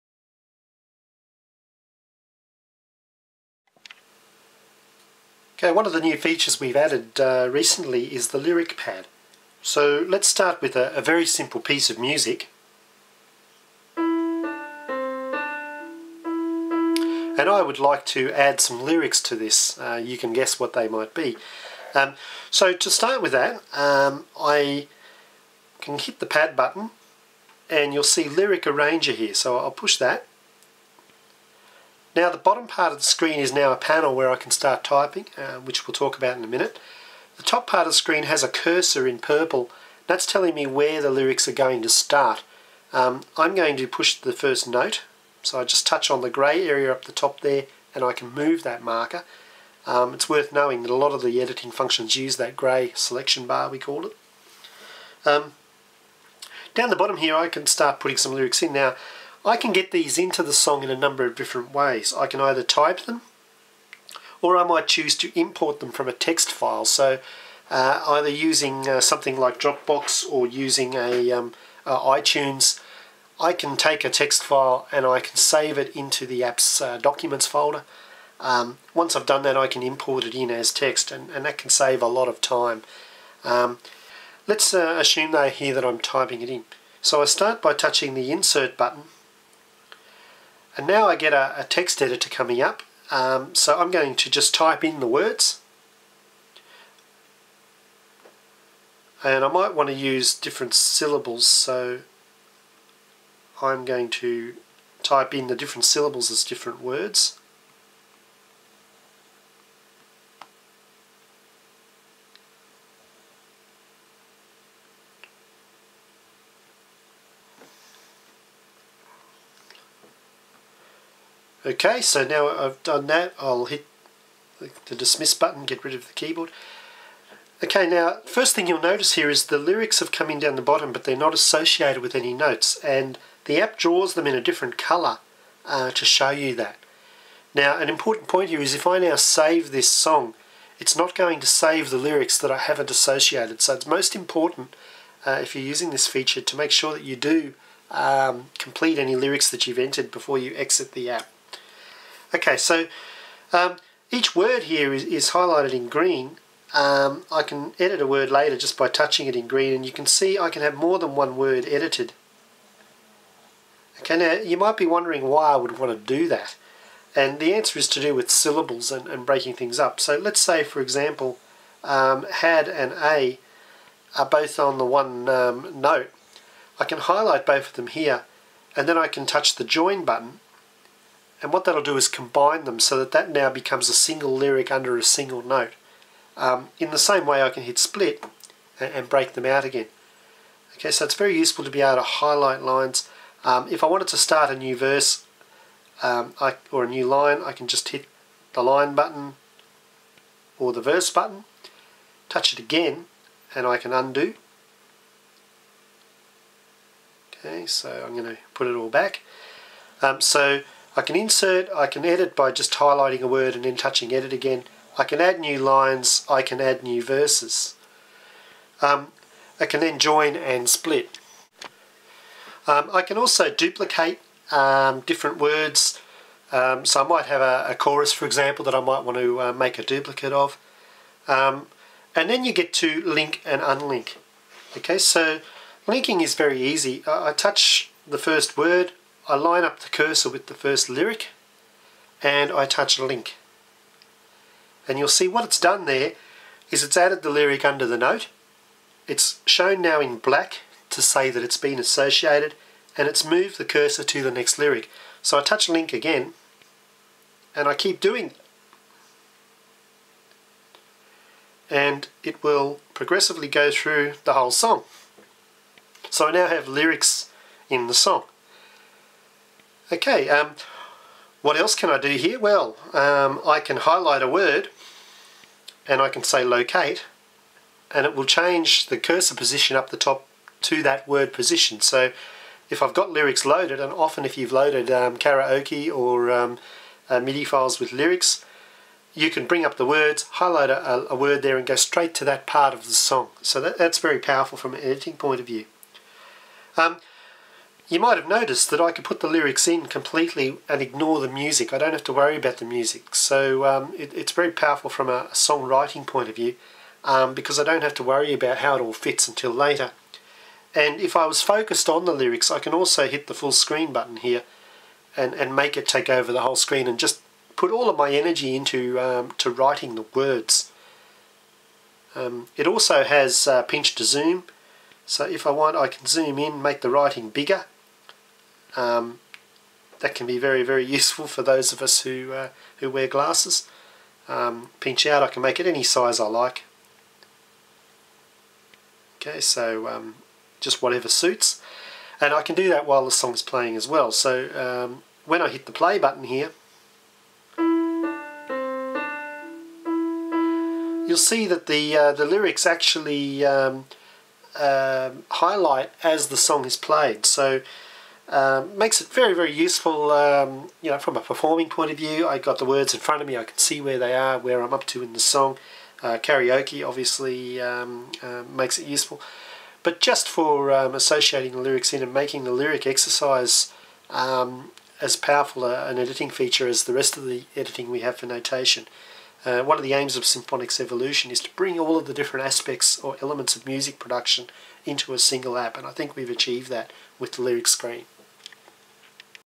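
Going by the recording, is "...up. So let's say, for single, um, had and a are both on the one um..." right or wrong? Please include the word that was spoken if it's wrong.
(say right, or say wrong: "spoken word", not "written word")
wrong: "example", not "single".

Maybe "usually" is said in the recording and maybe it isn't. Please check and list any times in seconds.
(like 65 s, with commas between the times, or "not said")
not said.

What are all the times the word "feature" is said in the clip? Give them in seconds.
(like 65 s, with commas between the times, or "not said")
6 s, 146 s, 376 s.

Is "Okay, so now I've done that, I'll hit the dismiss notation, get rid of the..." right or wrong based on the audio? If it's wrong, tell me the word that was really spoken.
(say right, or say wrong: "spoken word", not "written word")
wrong: "button", not "notation".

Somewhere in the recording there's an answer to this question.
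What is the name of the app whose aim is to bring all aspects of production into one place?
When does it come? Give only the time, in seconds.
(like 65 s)
380 s.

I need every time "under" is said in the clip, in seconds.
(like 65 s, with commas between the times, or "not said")
184 s, 247 s.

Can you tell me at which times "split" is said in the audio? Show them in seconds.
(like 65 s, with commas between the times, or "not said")
187 s, 220 s.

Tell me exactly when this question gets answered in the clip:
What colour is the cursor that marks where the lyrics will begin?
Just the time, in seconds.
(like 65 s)
39 s.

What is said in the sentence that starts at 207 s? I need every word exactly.
Okay, so I'm going to put it all back.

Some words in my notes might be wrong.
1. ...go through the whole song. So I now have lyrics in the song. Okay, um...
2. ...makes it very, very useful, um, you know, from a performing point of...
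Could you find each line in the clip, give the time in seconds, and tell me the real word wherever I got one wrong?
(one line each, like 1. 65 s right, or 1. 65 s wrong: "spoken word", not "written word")
1. 263 s right
2. 358 s right.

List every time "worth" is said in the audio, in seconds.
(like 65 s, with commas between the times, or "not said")
50 s.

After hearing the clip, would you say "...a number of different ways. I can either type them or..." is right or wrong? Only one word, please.
right.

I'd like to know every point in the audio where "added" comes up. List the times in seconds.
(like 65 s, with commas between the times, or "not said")
6 s, 246 s.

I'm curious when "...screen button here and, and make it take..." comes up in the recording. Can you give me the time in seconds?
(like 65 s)
313 s.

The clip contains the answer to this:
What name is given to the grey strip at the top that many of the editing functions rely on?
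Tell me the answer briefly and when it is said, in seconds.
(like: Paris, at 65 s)
Selection bar, at 52 s.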